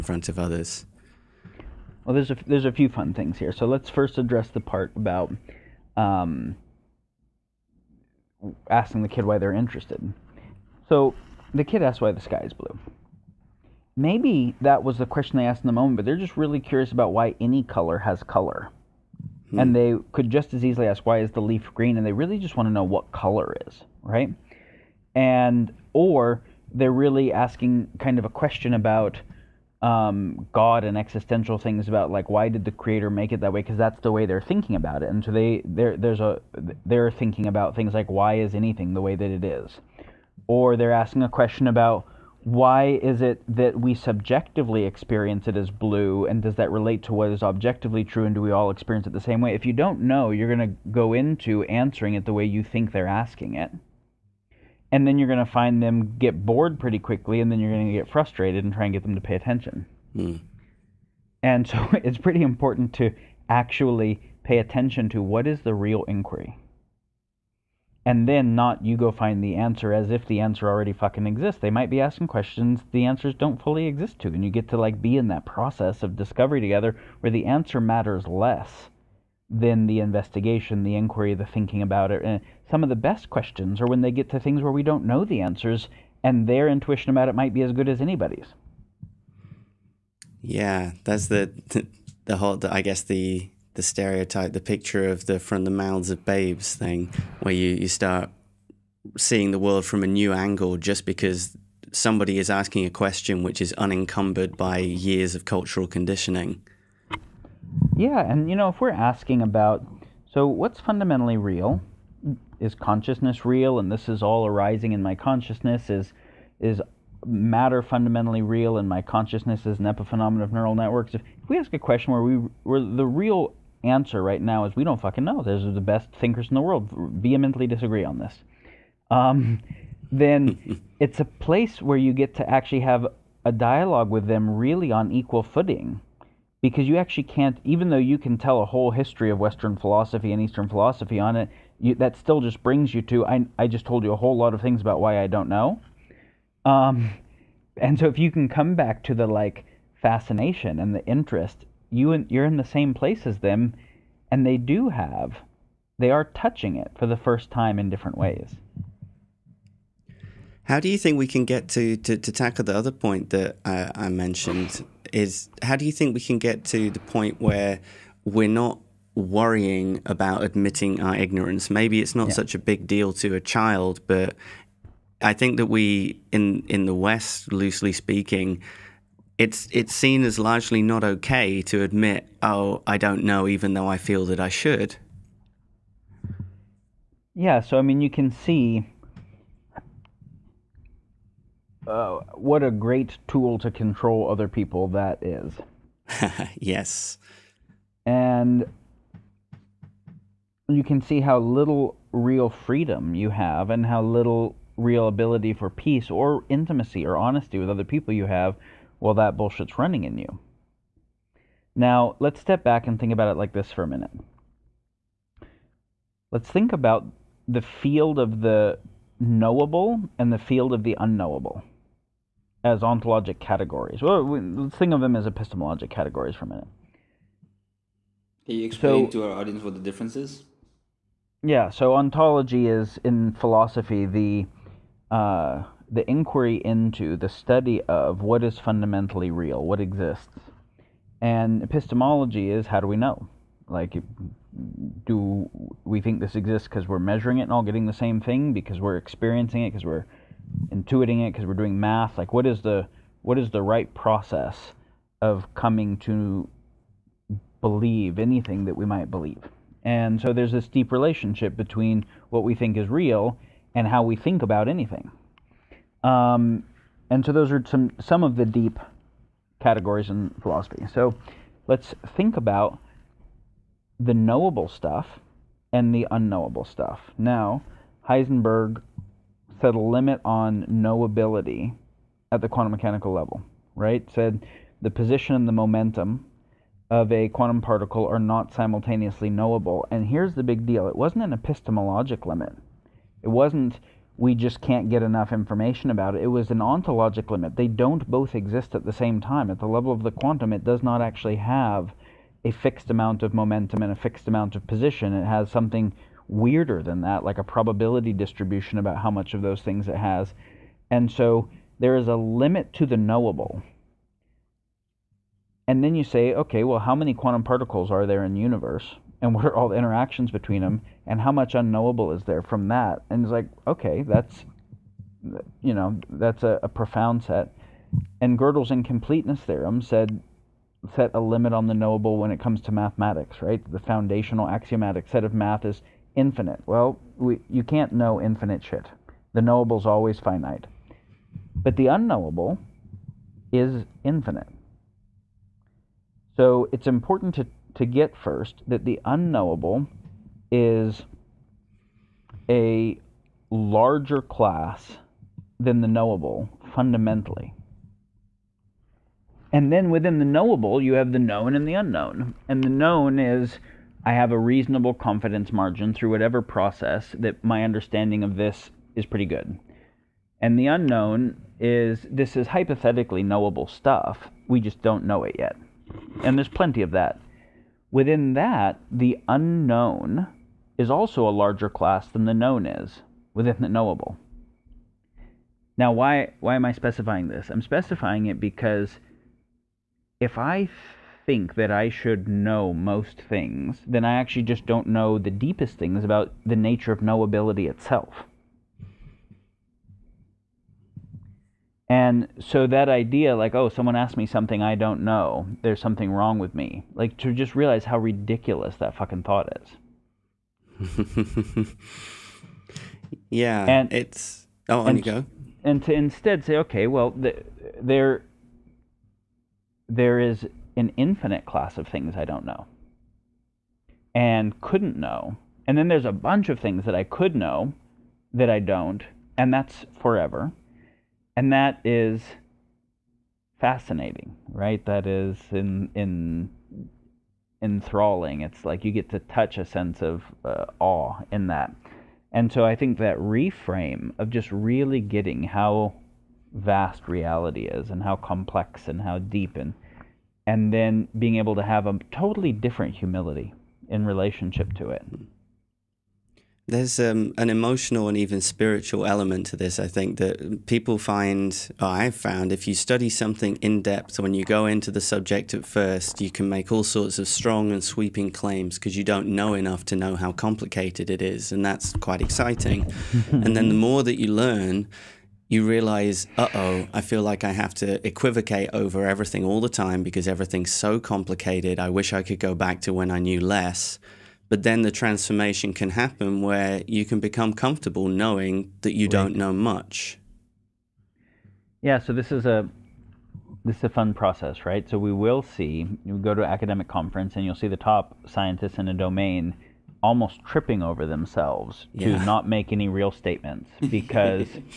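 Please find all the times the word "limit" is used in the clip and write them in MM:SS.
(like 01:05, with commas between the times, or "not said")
04:39, 04:52, 04:57, 05:12, 05:31.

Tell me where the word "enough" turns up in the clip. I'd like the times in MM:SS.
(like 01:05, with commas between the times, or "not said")
04:55, 07:49.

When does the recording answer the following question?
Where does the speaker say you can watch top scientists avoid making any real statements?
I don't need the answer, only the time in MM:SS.
08:16.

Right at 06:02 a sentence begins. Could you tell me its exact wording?
And the known is I have a reasonable confidence margin through whatever process that my understanding of this is pretty good.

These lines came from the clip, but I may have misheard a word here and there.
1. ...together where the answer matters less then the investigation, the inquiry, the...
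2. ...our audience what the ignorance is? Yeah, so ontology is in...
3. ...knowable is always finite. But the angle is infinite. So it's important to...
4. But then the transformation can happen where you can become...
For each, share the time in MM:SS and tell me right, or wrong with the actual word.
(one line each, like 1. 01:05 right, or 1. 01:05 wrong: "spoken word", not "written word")
1. 01:16 right
2. 03:49 wrong: "difference", not "ignorance"
3. 05:39 wrong: "unknowable", not "angle"
4. 08:04 right.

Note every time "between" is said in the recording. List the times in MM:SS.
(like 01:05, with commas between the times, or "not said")
04:21, 05:20.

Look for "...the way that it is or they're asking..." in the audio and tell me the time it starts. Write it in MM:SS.
00:38.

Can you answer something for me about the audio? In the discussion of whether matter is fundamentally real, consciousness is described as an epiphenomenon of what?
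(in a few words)
neural networks.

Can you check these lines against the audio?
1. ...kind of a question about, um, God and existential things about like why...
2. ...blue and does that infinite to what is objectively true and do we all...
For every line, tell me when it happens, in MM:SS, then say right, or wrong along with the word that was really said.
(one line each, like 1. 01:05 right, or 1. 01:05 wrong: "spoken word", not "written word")
1. 00:27 right
2. 00:45 wrong: "relate", not "infinite".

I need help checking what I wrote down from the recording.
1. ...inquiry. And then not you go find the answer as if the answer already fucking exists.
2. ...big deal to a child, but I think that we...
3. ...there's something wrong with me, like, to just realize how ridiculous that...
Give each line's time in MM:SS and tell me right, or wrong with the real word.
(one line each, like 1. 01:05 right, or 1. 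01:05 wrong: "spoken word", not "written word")
1. 01:06 right
2. 02:52 right
3. 06:45 right.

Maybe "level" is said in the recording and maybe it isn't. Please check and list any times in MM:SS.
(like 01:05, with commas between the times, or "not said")
04:43, 04:59.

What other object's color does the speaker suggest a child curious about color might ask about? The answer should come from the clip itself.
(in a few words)
leaf.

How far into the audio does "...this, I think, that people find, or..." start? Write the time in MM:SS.
07:39.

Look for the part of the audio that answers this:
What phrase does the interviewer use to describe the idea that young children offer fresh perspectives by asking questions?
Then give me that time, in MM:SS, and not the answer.
01:35.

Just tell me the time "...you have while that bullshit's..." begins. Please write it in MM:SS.
03:28.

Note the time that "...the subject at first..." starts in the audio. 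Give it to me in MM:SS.
07:44.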